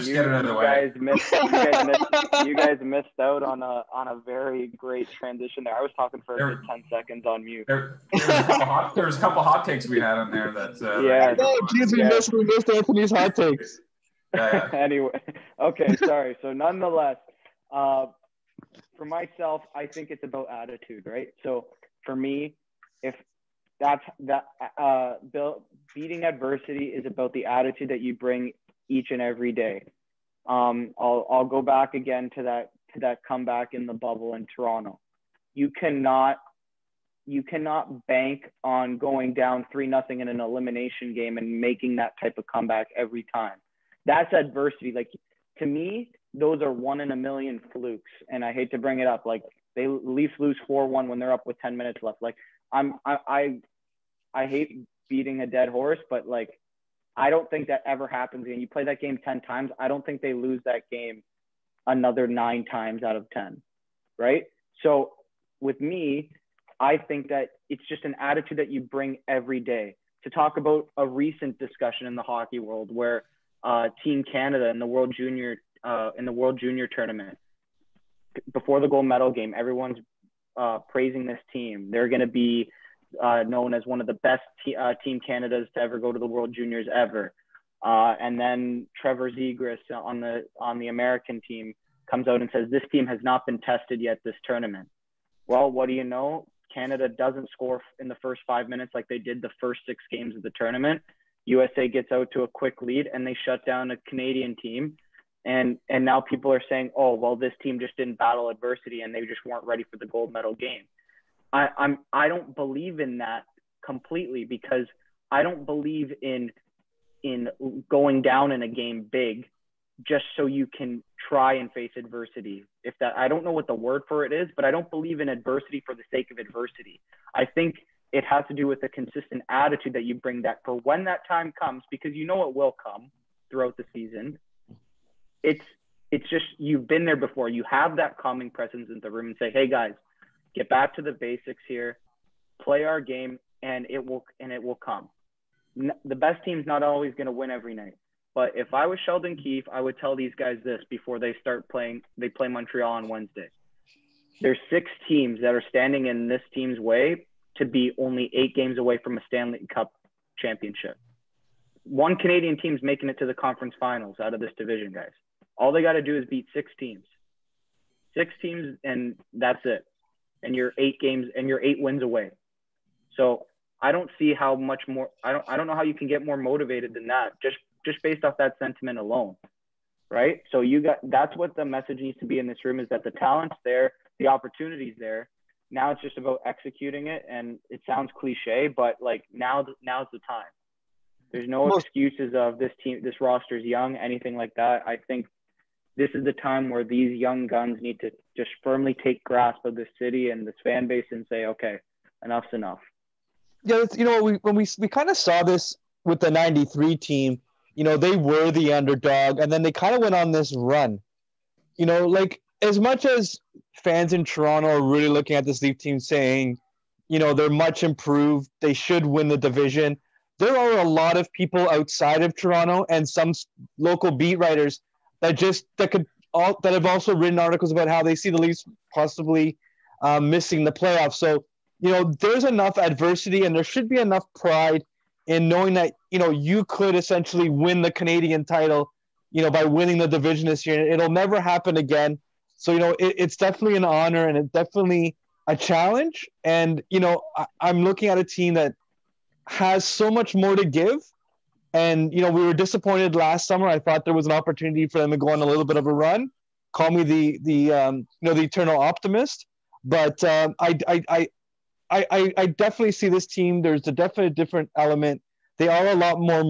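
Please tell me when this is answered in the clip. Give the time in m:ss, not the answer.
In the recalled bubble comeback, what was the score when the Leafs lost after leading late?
0:50.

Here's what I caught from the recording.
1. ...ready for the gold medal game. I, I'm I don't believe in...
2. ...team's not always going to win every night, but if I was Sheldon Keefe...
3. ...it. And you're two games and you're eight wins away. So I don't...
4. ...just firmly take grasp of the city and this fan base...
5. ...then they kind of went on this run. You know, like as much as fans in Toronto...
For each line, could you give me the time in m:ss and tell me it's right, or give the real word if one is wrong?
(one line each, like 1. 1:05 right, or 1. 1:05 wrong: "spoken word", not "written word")
1. 1:49 right
2. 2:26 right
3. 2:49 wrong: "eight", not "two"
4. 3:18 right
5. 3:29 right.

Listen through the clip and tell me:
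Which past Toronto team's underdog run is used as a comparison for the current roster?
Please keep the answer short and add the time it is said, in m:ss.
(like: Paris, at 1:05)
1993 team, at 3:26.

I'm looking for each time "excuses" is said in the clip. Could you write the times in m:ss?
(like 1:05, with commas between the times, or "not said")
3:11.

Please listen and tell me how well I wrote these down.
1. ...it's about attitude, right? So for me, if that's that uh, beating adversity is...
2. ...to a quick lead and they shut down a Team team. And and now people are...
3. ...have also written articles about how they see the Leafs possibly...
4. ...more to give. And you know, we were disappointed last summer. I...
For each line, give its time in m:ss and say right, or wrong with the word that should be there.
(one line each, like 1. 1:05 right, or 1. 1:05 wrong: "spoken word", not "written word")
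1. 0:20 right
2. 1:42 wrong: "Canadian", not "Team"
3. 3:46 right
4. 4:10 right.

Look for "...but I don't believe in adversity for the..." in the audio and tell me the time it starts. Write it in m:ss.
2:04.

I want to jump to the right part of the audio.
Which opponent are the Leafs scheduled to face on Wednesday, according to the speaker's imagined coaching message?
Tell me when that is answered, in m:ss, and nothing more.
2:32.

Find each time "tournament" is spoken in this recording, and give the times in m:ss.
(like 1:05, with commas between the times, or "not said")
1:16, 1:34, 1:40.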